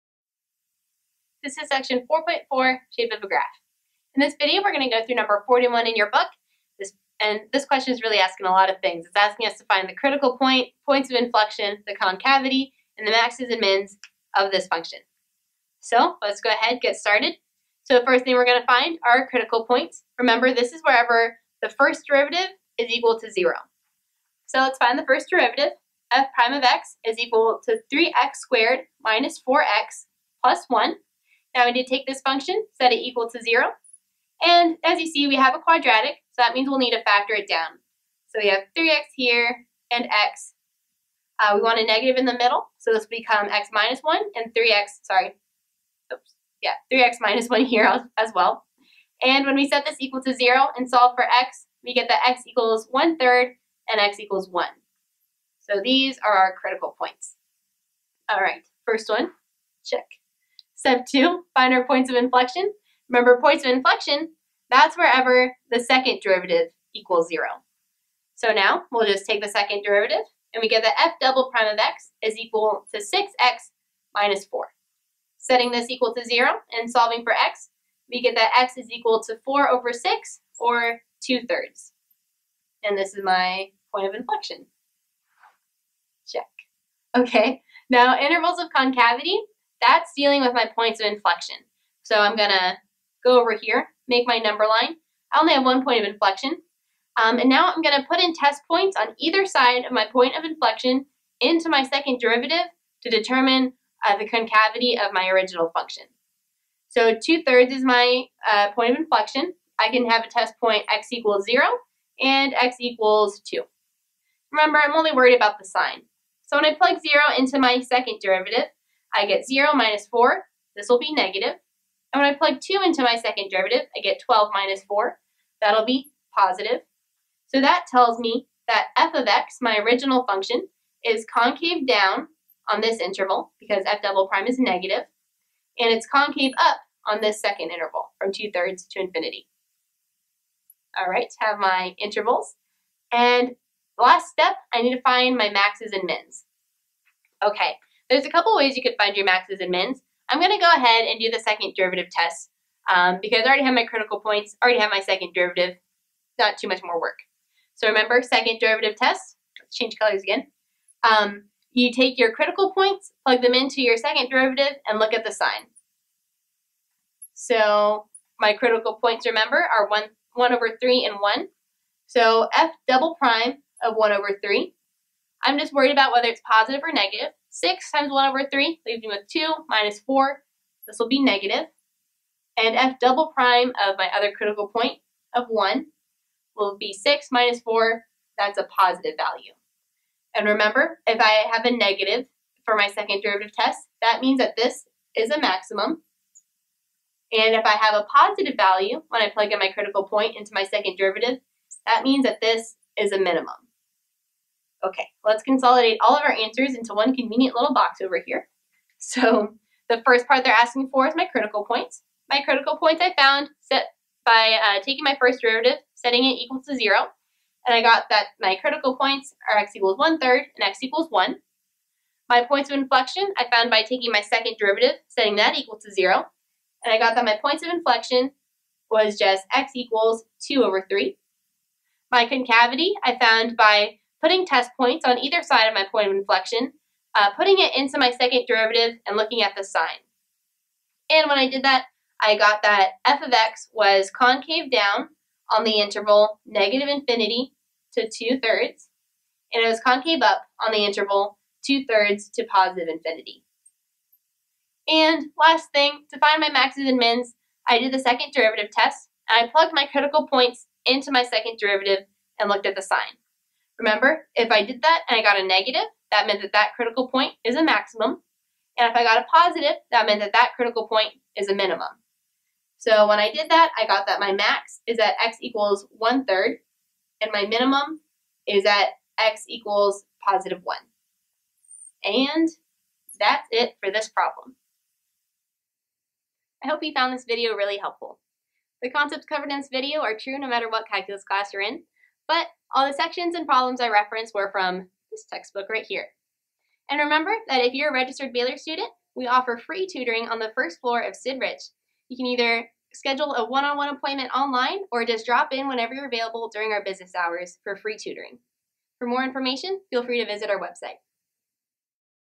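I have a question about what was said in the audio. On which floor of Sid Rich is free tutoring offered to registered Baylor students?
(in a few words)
first floor.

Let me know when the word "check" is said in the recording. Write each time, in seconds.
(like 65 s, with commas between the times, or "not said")
59 s, 86 s.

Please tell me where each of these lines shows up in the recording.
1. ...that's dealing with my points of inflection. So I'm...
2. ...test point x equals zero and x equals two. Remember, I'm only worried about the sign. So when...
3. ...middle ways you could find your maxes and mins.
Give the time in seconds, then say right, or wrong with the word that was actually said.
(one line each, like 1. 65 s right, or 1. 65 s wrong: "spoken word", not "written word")
1. 89 s right
2. 110 s right
3. 148 s wrong: "couple", not "middle".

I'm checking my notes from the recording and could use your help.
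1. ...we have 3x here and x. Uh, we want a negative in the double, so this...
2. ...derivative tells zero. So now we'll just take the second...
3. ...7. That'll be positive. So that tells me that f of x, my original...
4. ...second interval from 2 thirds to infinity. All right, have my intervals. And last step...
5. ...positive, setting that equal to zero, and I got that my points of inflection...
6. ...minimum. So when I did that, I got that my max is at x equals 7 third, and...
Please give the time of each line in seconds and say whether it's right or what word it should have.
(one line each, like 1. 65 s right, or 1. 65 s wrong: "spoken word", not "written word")
1. 38 s wrong: "middle", not "double"
2. 66 s wrong: "equals", not "tells"
3. 124 s wrong: "4", not "7"
4. 137 s right
5. 224 s wrong: "derivative", not "positive"
6. 271 s wrong: "1", not "7".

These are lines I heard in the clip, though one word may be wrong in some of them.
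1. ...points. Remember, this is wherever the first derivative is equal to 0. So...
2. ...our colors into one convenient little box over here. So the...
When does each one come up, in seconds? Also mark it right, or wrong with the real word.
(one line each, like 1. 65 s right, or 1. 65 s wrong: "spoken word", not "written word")
1. 19 s right
2. 206 s wrong: "answers", not "colors".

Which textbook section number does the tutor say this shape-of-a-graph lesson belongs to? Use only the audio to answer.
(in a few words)
4.4.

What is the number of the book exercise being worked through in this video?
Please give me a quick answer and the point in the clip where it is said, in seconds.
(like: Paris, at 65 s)
41, at 5 s.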